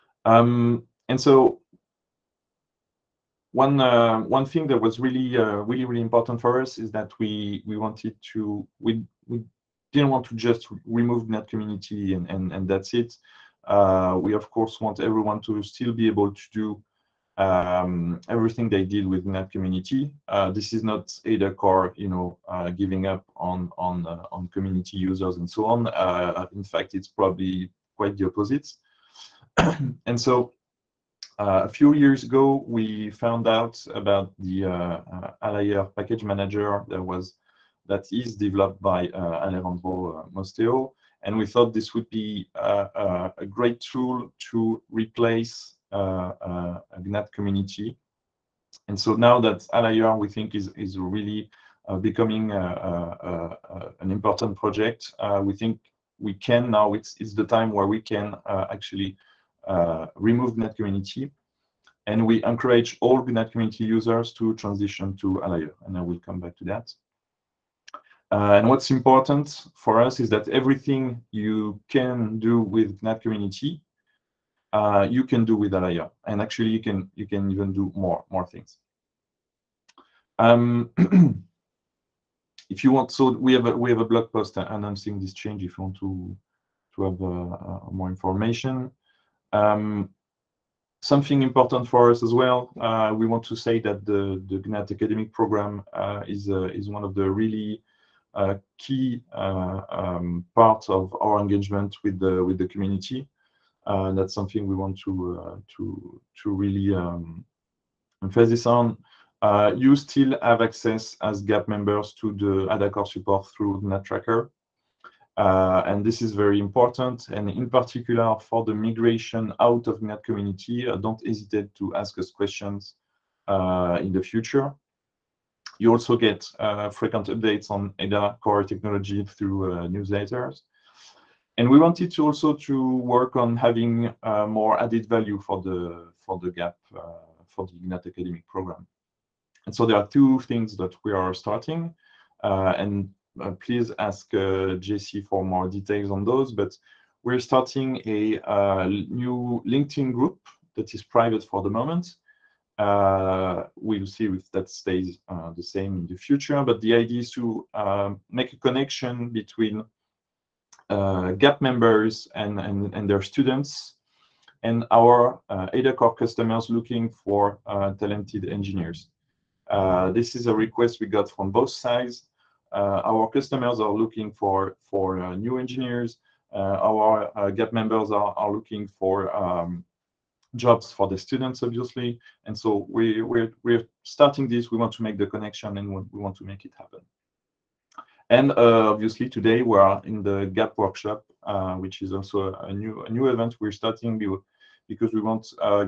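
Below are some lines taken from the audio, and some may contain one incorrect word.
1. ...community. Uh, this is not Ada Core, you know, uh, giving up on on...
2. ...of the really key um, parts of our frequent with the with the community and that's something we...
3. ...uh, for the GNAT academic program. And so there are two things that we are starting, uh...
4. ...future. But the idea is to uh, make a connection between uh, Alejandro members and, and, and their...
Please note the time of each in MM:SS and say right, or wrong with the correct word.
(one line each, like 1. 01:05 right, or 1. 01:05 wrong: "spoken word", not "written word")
1. 00:19 right
2. 01:37 wrong: "engagement", not "frequent"
3. 02:16 right
4. 02:36 wrong: "GAP", not "Alejandro".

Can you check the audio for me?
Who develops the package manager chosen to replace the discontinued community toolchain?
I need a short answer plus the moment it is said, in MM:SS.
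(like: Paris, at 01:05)
Alejandro Mosteo, at 00:39.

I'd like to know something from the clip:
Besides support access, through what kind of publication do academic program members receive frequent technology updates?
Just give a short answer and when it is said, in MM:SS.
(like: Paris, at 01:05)
Newsletters, at 02:09.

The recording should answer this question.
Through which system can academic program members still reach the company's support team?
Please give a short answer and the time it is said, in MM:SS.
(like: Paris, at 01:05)
GNATtracker, at 01:53.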